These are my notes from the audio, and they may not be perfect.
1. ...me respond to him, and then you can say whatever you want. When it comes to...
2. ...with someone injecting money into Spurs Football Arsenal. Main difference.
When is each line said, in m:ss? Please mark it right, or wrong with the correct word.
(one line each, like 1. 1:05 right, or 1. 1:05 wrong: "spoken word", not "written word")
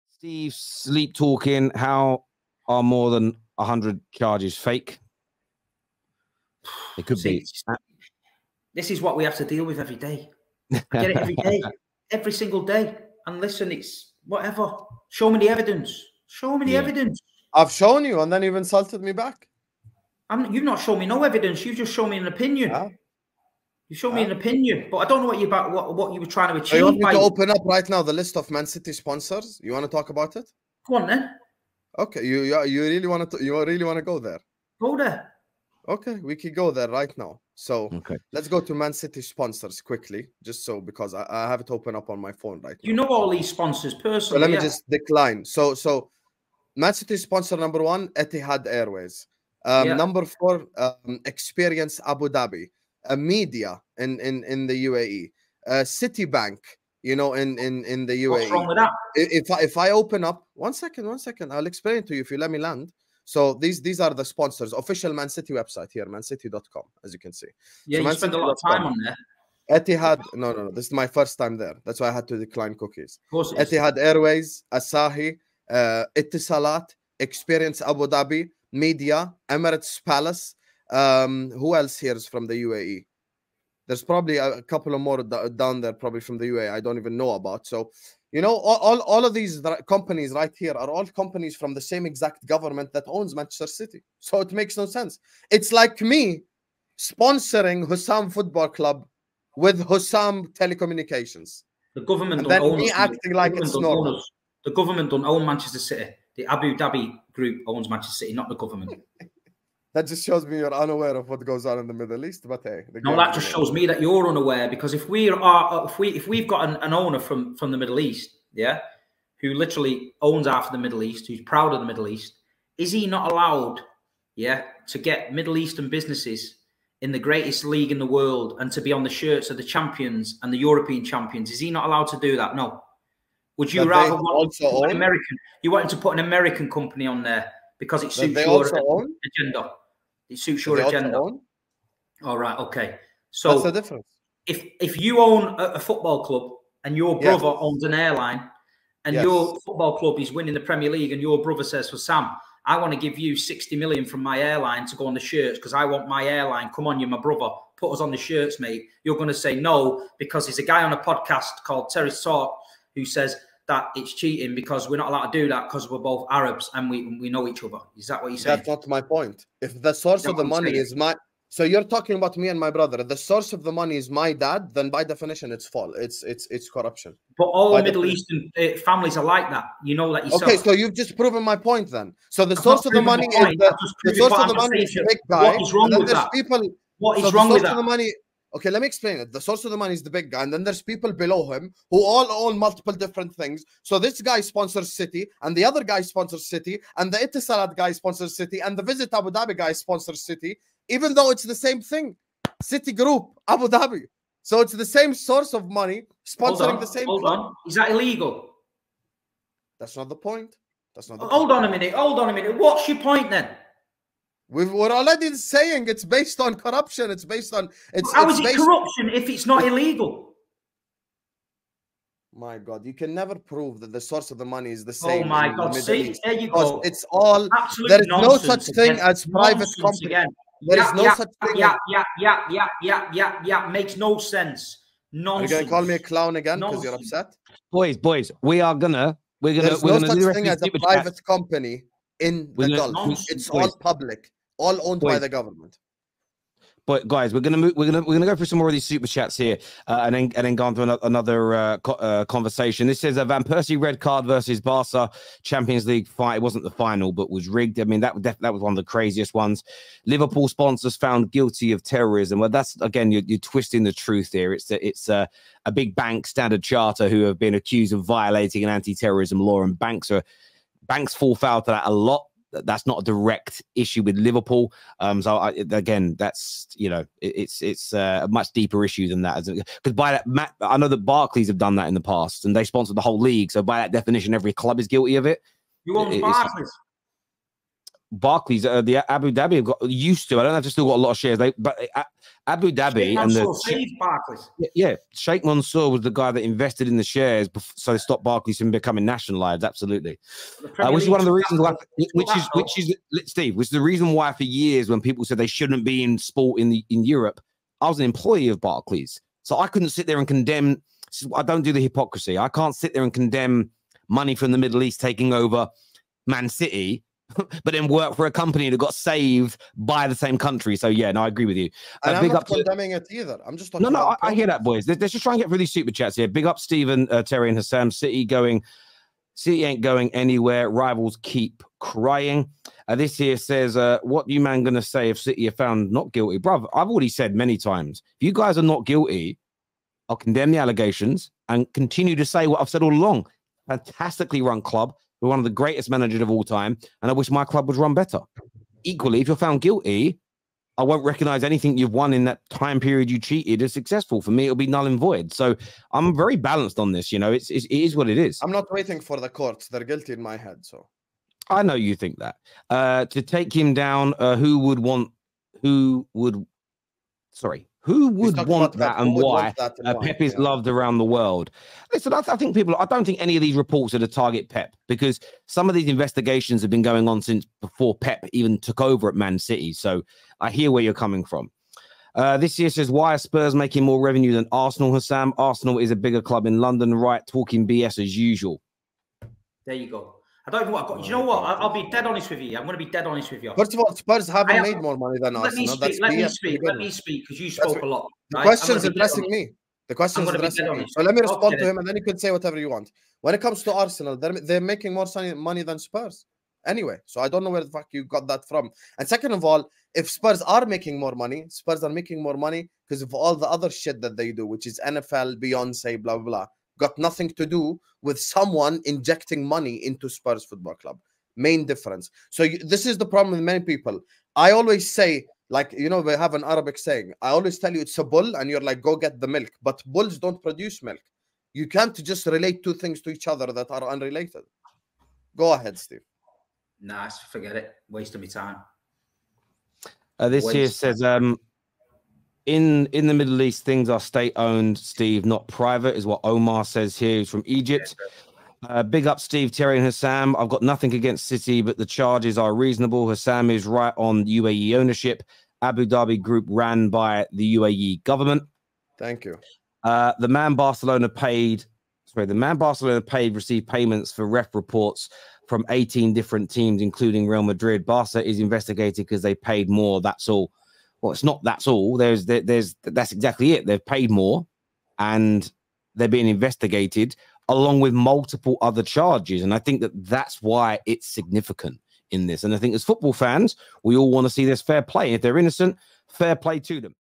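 1. 6:41 right
2. 6:58 wrong: "Club", not "Arsenal".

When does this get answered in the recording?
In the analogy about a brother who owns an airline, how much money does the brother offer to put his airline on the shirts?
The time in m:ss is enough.
2:33.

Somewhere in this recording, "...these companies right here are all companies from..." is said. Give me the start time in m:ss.
1:29.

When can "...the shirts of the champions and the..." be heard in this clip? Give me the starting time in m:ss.
2:09.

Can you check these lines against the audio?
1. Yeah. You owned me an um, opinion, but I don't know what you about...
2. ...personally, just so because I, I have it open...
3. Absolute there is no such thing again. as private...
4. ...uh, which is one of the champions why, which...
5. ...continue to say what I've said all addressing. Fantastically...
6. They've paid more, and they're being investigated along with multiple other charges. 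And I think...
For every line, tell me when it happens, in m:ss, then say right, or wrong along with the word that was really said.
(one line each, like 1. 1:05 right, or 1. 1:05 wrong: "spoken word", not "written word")
1. 0:22 wrong: "showed", not "owned"
2. 0:39 wrong: "quickly", not "personally"
3. 3:47 right
4. 5:00 wrong: "reasons", not "champions"
5. 5:41 wrong: "along", not "addressing"
6. 7:53 right.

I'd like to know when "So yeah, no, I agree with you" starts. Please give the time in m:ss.
5:20.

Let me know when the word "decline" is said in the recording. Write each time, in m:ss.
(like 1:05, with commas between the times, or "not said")
0:44, 1:12.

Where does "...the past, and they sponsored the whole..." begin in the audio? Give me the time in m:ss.
4:41.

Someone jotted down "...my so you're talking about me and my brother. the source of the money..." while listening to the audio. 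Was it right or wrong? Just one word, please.
right.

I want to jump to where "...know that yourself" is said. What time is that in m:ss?
2:59.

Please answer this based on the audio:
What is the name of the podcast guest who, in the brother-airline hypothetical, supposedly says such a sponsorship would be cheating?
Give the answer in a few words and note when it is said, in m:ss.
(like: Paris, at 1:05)
Terry Sort, at 2:41.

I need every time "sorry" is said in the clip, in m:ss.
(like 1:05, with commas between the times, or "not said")
6:07, 7:42.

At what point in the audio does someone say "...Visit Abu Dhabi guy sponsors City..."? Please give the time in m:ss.
3:18.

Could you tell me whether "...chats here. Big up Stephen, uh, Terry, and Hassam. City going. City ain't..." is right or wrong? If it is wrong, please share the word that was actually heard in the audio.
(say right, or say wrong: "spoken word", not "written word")
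right.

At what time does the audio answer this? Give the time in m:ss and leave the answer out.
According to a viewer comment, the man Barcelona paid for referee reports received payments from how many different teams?
7:45.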